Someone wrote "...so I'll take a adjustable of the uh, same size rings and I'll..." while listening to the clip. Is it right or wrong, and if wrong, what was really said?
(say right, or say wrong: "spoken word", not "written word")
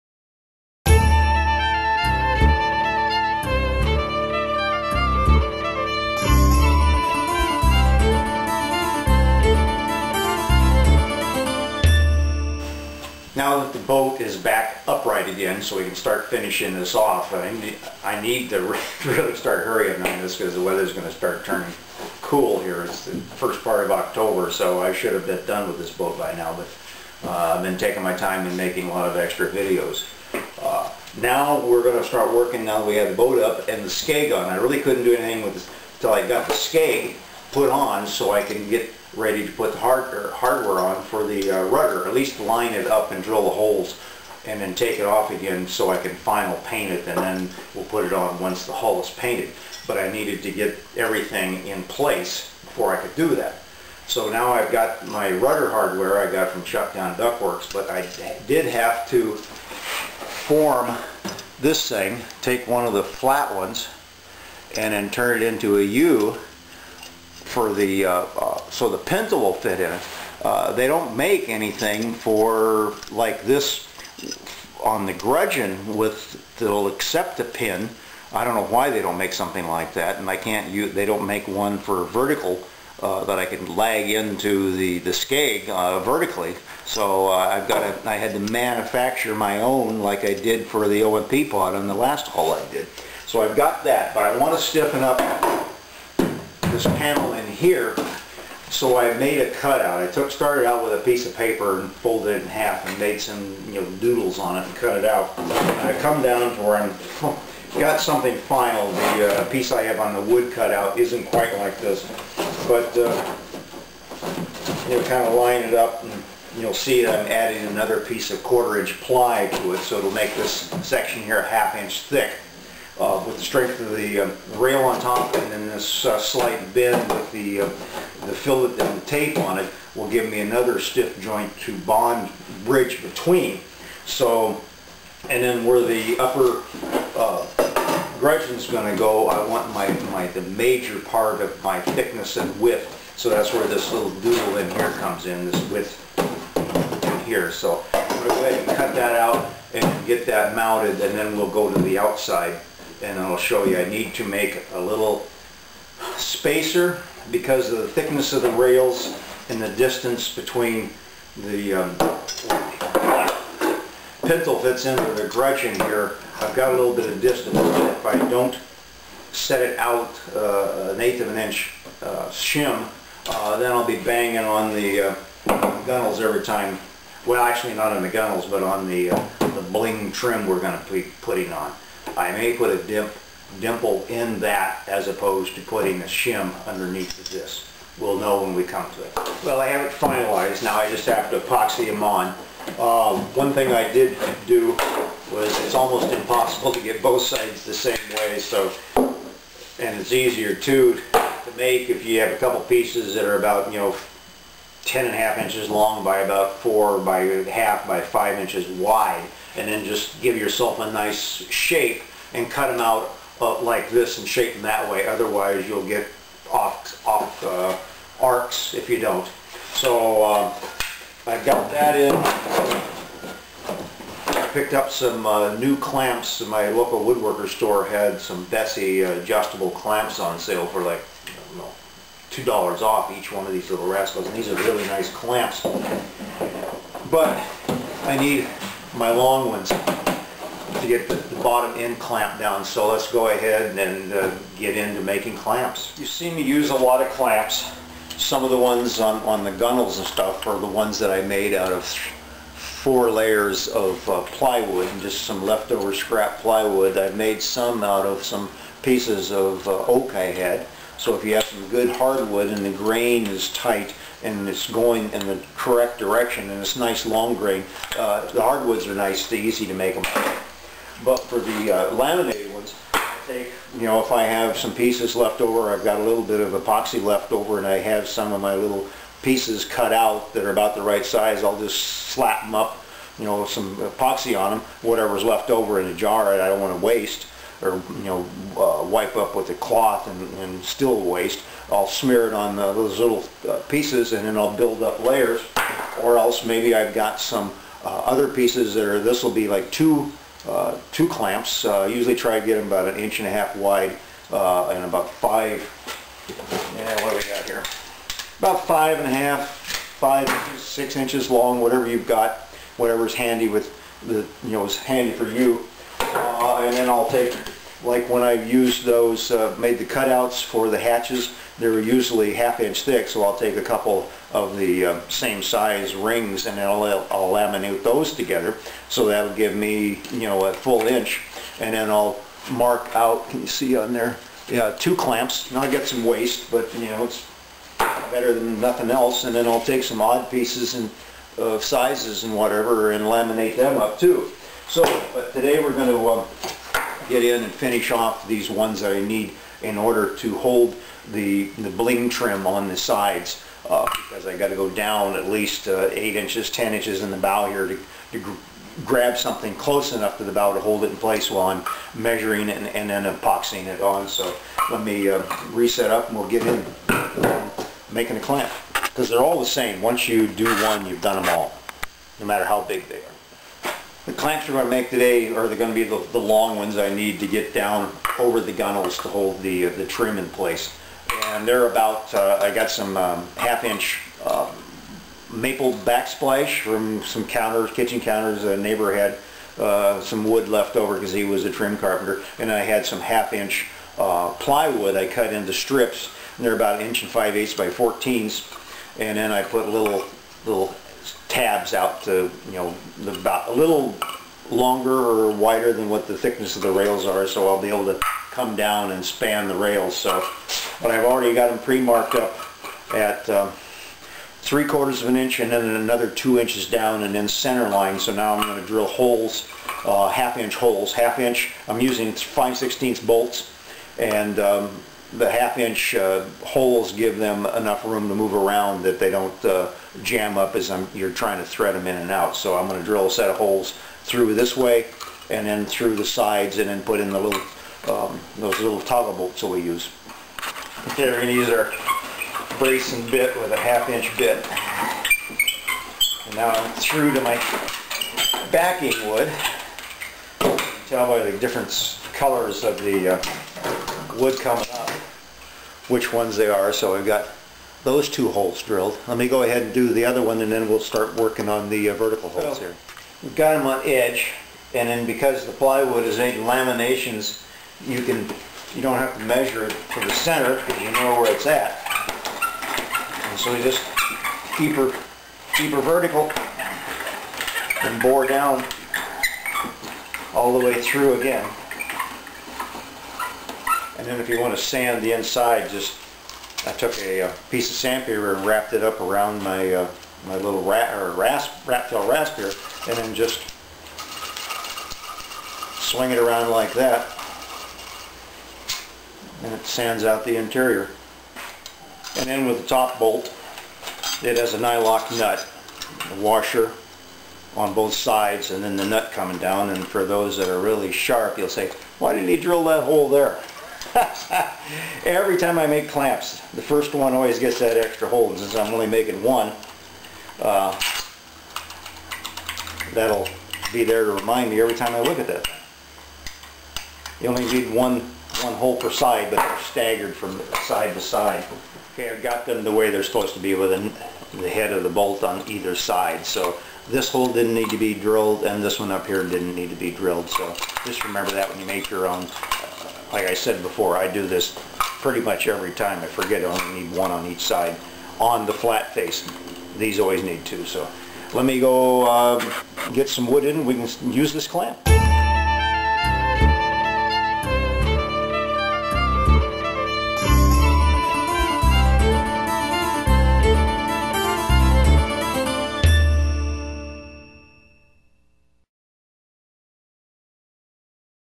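wrong: "couple", not "adjustable".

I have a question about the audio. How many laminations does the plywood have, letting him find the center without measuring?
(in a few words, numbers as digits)
8.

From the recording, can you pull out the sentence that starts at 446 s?
And now I'm through to my backing wood.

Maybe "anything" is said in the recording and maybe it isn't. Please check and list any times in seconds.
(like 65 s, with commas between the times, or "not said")
35 s, 71 s.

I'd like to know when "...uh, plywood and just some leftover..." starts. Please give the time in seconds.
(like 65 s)
254 s.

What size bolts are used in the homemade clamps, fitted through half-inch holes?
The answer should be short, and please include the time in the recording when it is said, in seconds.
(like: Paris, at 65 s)
5/16, at 422 s.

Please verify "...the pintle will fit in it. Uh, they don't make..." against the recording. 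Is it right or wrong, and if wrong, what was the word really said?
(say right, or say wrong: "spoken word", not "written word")
right.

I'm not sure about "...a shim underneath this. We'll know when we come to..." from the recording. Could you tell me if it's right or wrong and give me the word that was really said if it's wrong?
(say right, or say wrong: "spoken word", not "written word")
right.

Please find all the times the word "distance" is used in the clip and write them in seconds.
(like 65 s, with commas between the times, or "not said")
159 s, 167 s.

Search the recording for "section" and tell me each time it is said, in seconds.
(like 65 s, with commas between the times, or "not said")
120 s.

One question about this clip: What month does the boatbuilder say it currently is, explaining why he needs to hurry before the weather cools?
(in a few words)
October.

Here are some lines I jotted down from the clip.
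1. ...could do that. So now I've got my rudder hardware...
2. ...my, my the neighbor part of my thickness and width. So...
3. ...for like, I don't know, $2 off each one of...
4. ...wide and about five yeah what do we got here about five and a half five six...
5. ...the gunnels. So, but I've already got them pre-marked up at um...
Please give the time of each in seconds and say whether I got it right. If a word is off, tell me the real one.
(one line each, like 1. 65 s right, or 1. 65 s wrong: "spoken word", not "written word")
1. 53 s right
2. 139 s wrong: "major", not "neighbor"
3. 230 s right
4. 303 s right
5. 409 s wrong: "rails", not "gunnels".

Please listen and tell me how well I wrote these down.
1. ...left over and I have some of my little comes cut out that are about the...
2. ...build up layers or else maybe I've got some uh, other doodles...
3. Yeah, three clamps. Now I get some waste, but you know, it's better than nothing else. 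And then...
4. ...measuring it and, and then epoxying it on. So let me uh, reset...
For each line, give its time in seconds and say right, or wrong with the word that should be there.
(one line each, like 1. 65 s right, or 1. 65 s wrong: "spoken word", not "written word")
1. 277 s wrong: "pieces", not "comes"
2. 294 s wrong: "pieces", not "doodles"
3. 334 s wrong: "two", not "three"
4. 361 s right.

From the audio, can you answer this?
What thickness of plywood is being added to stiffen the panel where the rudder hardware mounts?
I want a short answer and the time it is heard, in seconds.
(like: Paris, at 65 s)
quarter inch, at 118 s.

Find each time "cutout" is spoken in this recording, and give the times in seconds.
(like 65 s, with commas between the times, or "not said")
99 s, 110 s, 319 s.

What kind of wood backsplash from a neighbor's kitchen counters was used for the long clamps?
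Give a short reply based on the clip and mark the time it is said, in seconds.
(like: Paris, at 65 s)
maple, at 385 s.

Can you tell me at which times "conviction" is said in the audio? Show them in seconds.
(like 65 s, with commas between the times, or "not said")
not said.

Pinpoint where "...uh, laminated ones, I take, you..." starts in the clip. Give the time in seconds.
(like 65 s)
271 s.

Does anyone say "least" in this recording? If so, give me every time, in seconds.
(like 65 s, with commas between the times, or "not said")
42 s, 355 s.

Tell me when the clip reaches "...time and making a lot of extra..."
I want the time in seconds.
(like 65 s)
28 s.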